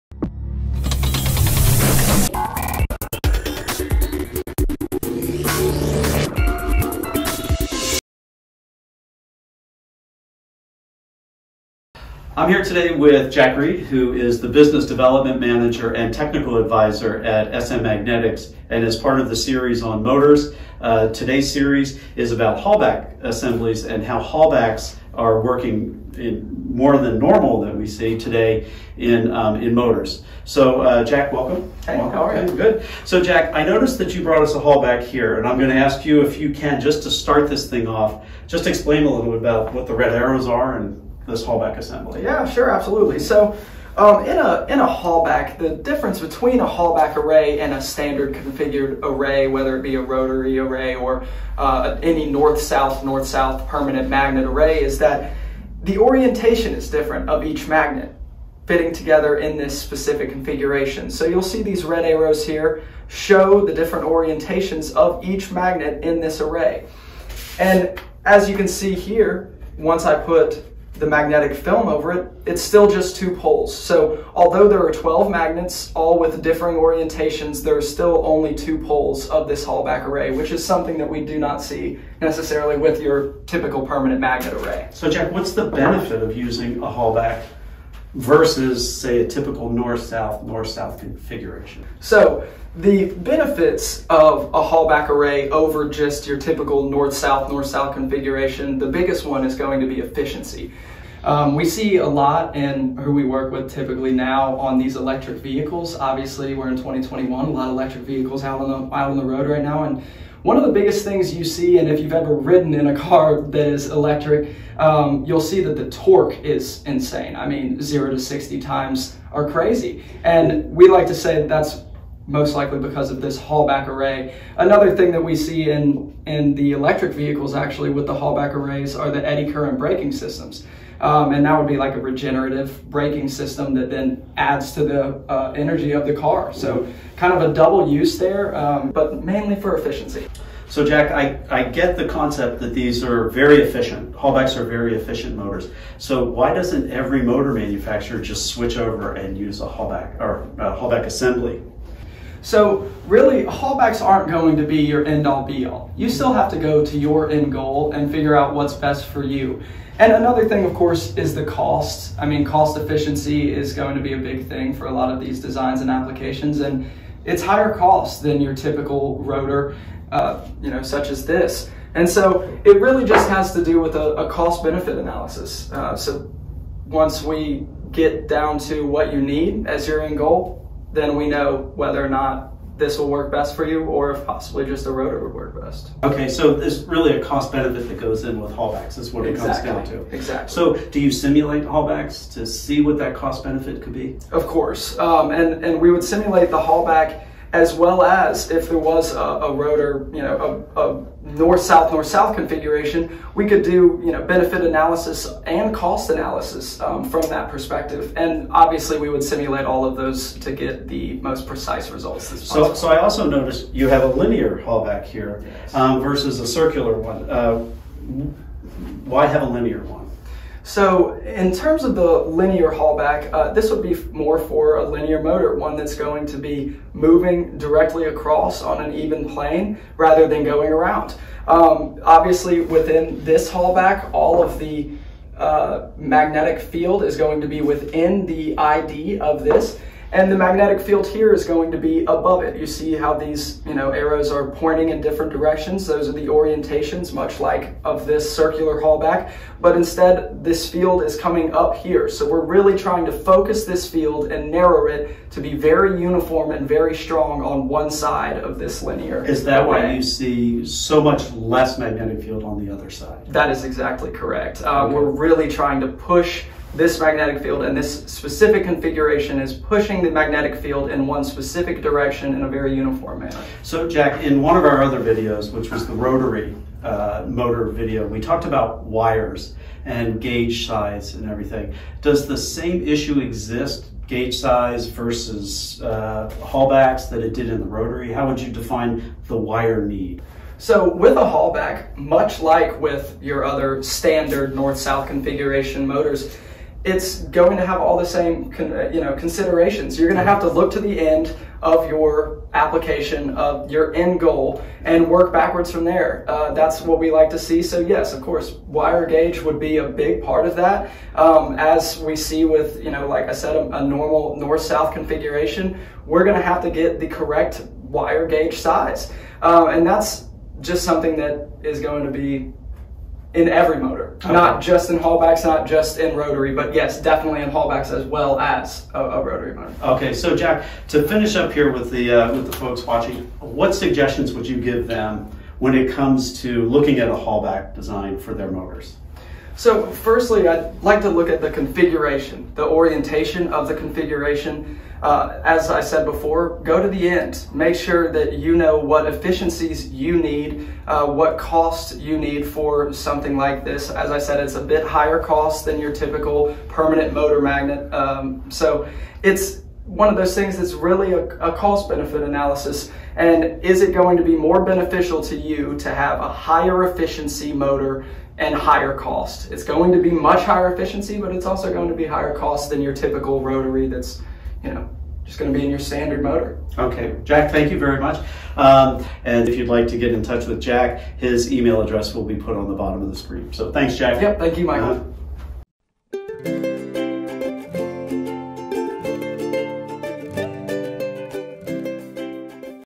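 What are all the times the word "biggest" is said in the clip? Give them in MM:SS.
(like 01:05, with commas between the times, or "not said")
01:38, 01:50.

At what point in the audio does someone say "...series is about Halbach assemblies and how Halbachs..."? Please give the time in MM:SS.
00:21.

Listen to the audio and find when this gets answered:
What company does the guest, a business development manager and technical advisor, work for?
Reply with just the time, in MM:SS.
00:17.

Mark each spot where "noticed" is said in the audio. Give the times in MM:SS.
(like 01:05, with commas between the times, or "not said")
00:33, 03:33.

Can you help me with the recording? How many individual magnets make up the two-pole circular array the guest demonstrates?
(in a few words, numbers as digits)
12.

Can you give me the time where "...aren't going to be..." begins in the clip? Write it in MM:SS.
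02:34.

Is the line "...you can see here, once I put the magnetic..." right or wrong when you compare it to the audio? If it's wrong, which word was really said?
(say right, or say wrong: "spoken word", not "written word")
right.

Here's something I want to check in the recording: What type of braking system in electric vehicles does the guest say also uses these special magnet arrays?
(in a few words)
Eddy current braking.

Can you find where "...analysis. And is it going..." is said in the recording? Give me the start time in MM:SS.
06:02.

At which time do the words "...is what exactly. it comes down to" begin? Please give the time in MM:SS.
03:08.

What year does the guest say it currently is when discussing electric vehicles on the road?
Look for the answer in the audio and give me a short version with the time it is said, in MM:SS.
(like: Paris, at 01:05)
2021, at 01:46.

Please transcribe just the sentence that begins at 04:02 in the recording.
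You see how these you know, arrows are pointing in different directions.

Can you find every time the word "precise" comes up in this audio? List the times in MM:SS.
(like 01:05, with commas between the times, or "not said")
03:31.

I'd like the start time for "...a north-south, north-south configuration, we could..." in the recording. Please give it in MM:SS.
03:20.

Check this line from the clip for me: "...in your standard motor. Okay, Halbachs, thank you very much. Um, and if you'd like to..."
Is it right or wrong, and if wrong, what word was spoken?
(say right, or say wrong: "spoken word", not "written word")
wrong: "Jack", not "Halbachs".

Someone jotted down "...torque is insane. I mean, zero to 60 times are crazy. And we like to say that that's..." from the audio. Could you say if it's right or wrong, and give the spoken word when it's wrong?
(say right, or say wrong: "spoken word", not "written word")
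right.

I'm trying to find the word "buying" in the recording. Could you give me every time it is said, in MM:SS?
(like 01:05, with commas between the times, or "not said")
not said.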